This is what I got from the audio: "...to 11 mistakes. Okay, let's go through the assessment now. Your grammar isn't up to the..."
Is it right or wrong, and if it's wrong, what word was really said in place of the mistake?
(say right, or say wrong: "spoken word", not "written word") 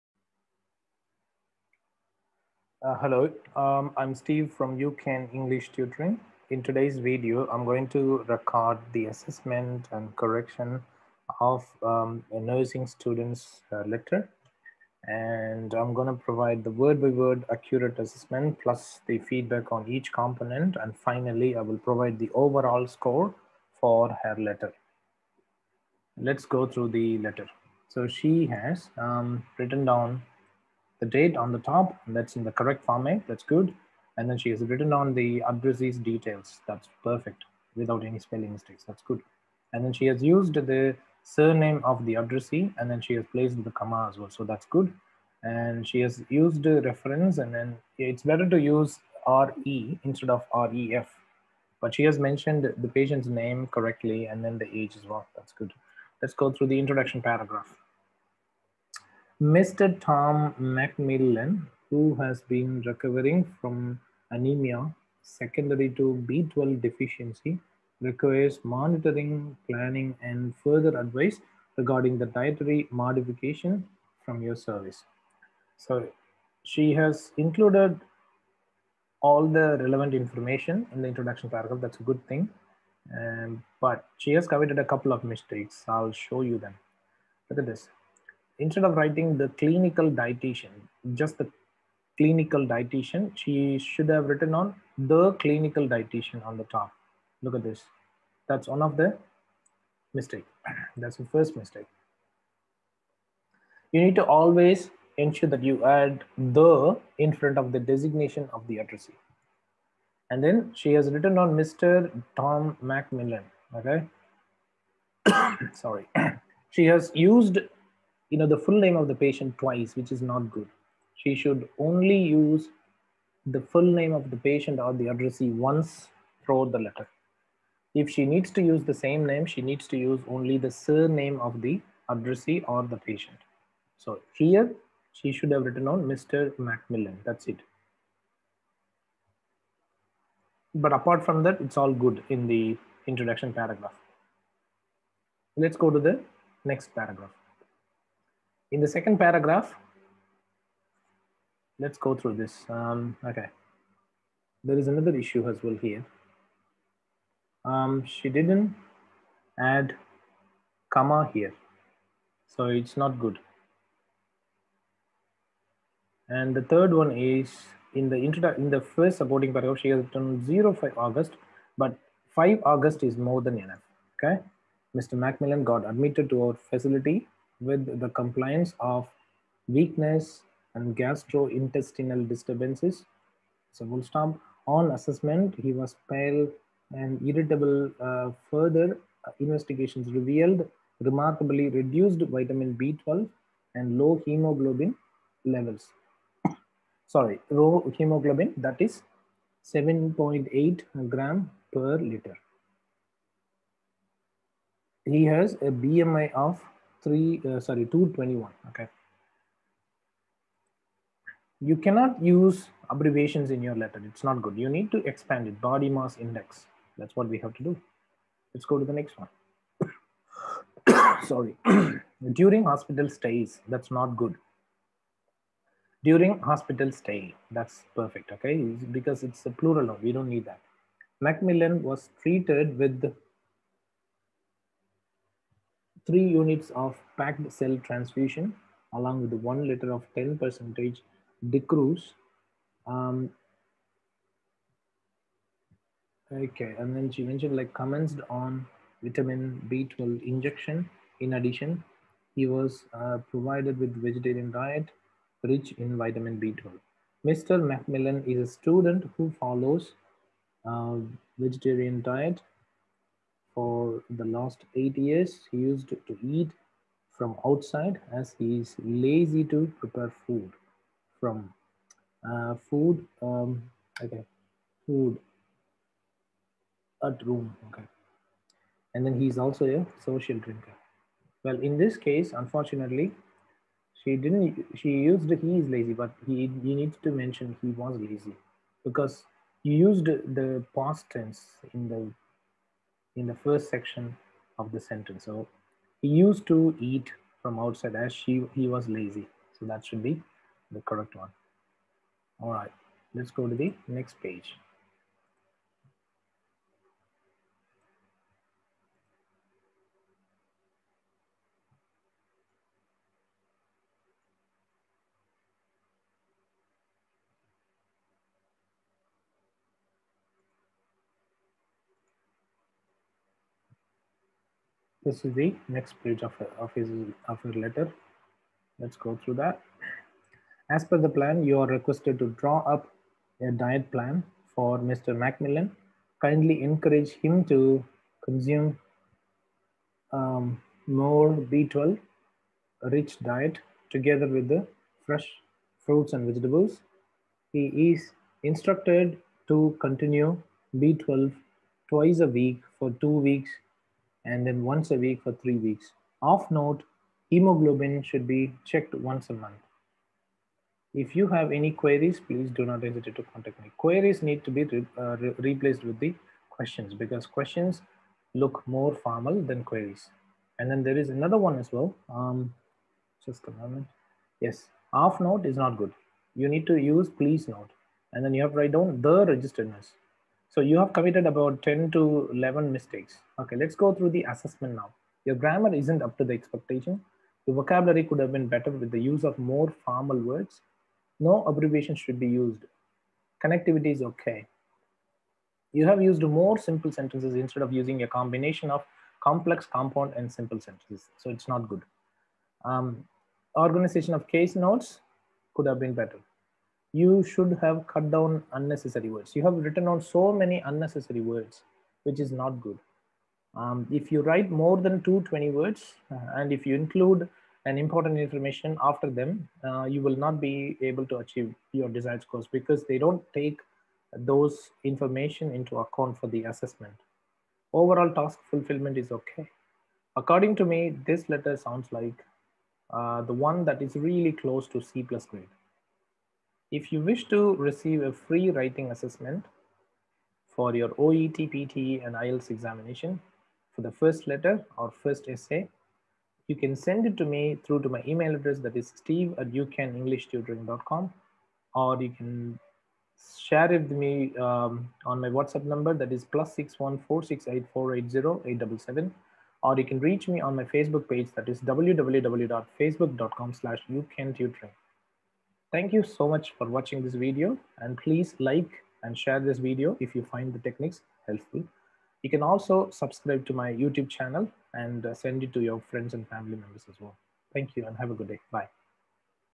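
right.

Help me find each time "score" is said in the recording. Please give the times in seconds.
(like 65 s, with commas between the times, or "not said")
22 s, 422 s.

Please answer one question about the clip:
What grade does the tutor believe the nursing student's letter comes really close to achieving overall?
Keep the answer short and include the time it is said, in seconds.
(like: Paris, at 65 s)
C plus, at 434 s.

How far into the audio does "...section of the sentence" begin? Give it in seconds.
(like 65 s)
293 s.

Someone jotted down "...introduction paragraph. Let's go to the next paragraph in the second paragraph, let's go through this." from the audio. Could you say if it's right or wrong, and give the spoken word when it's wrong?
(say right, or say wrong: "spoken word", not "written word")
right.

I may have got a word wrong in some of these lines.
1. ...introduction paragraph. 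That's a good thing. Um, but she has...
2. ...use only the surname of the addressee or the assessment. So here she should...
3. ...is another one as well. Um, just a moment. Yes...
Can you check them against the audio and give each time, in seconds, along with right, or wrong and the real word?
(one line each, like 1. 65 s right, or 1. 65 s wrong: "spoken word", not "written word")
1. 81 s right
2. 129 s wrong: "patient", not "assessment"
3. 370 s right.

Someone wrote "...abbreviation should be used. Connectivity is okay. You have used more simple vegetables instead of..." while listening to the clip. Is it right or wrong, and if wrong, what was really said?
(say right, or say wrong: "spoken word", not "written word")
wrong: "sentences", not "vegetables".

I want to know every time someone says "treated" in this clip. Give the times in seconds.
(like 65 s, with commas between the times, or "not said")
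232 s.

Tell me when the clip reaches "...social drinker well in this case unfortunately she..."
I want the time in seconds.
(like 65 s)
280 s.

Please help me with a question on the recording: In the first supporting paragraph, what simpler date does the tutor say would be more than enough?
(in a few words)
5 August.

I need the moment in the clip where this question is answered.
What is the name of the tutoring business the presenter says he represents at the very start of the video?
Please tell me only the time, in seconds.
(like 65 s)
4 s.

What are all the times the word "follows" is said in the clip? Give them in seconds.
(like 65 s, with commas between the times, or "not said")
259 s.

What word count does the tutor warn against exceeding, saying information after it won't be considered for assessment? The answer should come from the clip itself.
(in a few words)
220.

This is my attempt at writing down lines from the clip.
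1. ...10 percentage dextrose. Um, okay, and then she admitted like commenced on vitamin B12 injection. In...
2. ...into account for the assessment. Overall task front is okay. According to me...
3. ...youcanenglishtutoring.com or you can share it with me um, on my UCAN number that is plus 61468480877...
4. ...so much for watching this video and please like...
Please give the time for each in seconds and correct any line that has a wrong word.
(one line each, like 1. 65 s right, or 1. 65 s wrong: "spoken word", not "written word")
1. 240 s wrong: "mentioned", not "admitted"
2. 425 s wrong: "fulfillment", not "front"
3. 449 s wrong: "WhatsApp", not "UCAN"
4. 466 s right.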